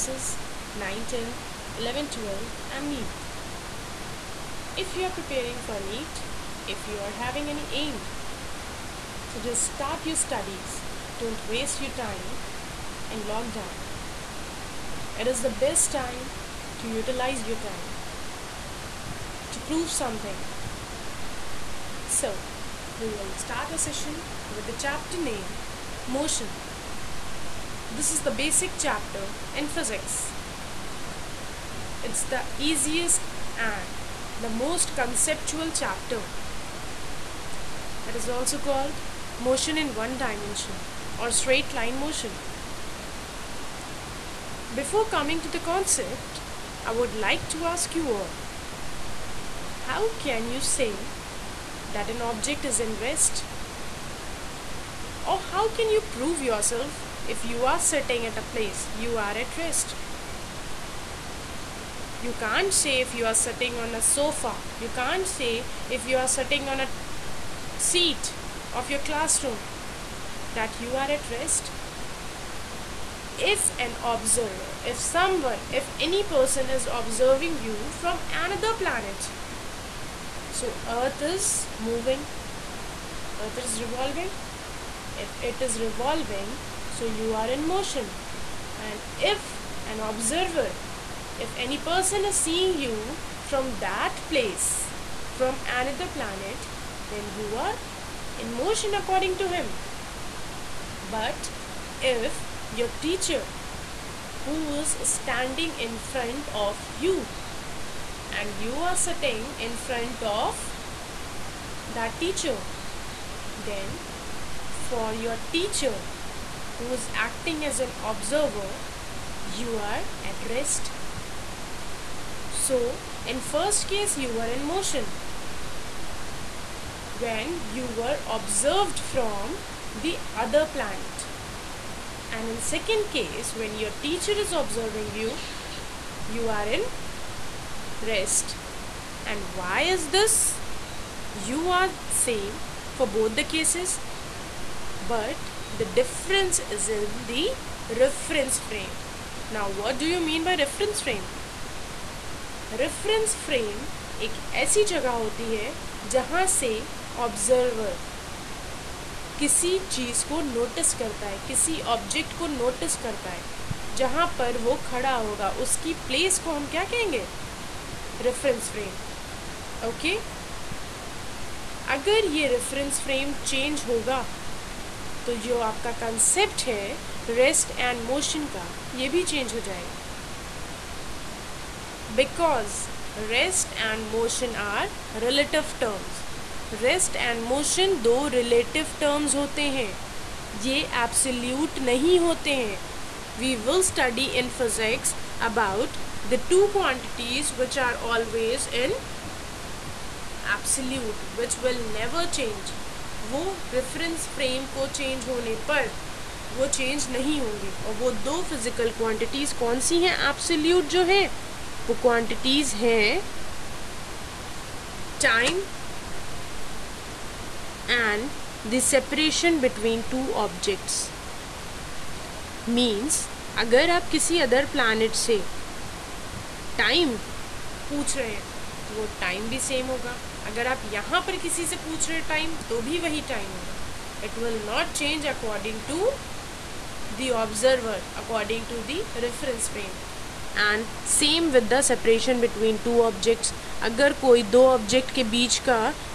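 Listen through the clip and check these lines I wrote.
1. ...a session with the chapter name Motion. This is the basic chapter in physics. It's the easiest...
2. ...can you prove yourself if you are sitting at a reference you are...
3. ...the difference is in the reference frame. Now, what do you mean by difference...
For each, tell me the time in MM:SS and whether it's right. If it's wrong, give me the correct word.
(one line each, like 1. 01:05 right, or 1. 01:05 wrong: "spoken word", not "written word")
1. 00:23 right
2. 00:55 wrong: "place", not "reference"
3. 02:25 wrong: "reference", not "difference".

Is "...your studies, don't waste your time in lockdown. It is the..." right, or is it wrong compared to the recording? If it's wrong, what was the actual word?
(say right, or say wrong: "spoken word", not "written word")
right.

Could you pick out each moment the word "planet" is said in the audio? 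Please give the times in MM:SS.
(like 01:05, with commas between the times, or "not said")
01:18, 01:36, 02:10.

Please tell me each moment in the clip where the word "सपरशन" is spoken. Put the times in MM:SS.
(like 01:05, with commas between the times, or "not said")
03:38, 04:01.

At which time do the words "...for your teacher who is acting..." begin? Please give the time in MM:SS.
01:54.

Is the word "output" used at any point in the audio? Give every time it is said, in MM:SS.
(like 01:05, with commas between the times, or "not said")
not said.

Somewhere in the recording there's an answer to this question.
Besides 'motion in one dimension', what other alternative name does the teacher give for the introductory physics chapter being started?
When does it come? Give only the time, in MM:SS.
00:41.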